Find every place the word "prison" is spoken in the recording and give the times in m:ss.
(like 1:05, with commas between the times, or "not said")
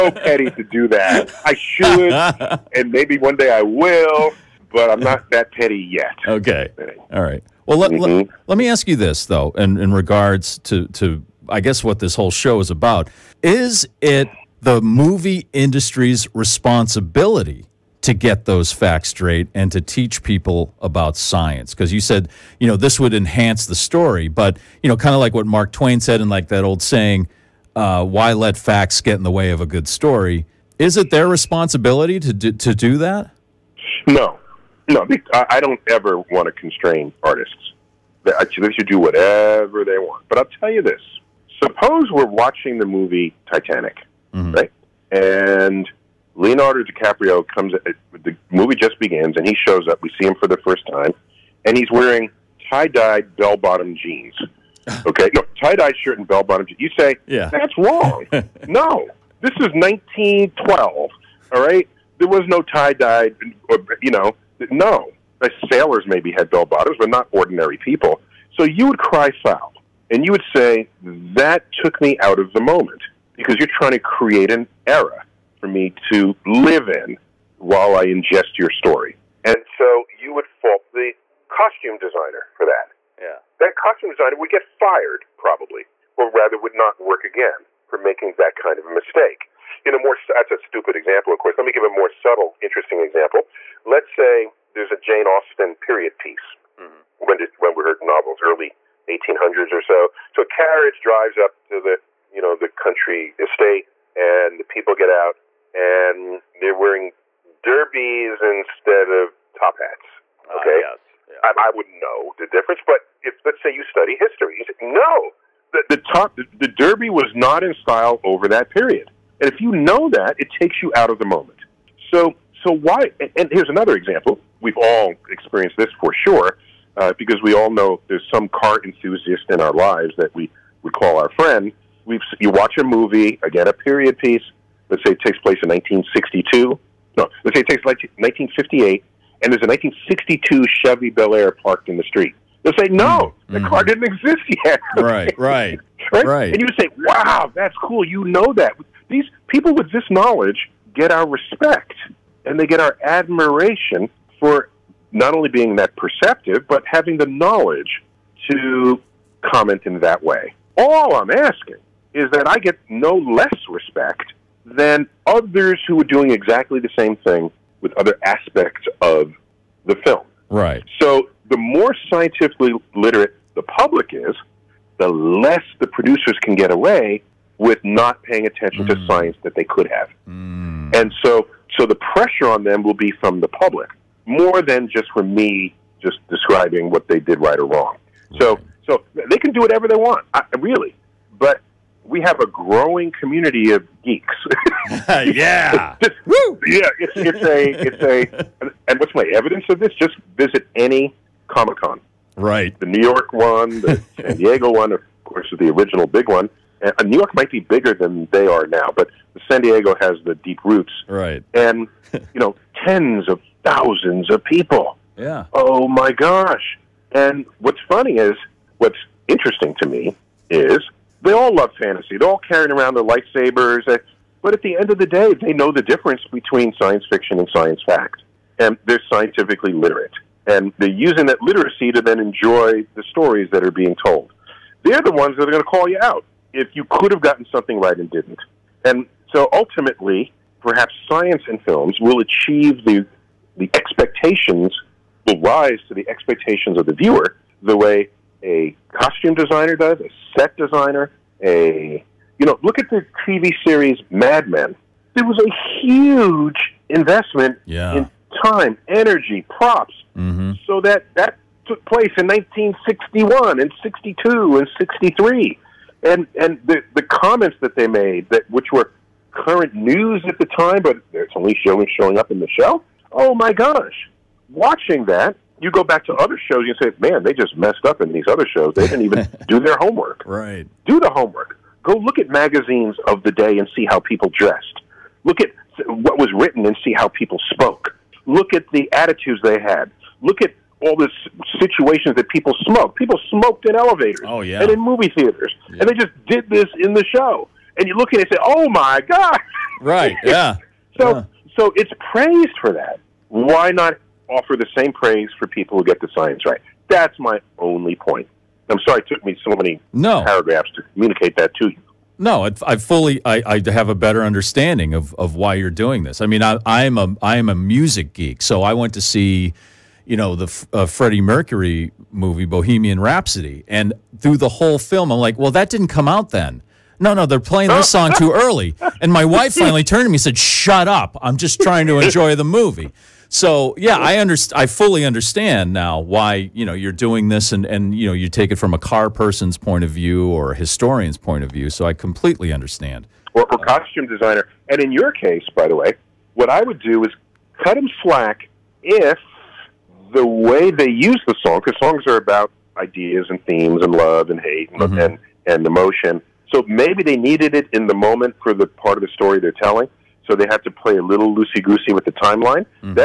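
not said.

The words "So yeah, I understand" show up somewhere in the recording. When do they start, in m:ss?
5:33.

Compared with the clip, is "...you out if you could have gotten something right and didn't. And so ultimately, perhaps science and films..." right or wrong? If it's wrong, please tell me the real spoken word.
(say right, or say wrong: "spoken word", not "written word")
right.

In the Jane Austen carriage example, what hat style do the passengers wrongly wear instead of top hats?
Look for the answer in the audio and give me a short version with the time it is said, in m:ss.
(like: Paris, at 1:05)
derbies, at 1:47.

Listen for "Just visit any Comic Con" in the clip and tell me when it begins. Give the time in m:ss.
3:19.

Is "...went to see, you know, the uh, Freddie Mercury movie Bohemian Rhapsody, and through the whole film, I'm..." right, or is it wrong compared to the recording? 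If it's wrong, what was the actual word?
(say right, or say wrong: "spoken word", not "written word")
right.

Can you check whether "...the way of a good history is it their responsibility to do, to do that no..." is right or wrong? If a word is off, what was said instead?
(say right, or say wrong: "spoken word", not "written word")
wrong: "story", not "history".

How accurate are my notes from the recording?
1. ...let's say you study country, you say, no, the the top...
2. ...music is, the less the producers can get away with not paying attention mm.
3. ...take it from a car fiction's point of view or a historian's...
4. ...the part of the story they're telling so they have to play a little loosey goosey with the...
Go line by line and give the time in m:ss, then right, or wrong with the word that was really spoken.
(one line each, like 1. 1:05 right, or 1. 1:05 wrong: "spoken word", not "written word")
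1. 1:53 wrong: "history", not "country"
2. 2:53 wrong: "public", not "music"
3. 5:38 wrong: "person", not "fiction"
4. 5:58 right.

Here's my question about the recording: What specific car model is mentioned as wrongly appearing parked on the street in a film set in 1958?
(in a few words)
Chevy Bel Air.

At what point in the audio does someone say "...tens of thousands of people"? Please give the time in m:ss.
3:32.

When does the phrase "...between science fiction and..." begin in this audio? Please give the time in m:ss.
3:46.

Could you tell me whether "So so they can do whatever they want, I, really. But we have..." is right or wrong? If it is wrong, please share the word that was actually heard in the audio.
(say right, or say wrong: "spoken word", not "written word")
right.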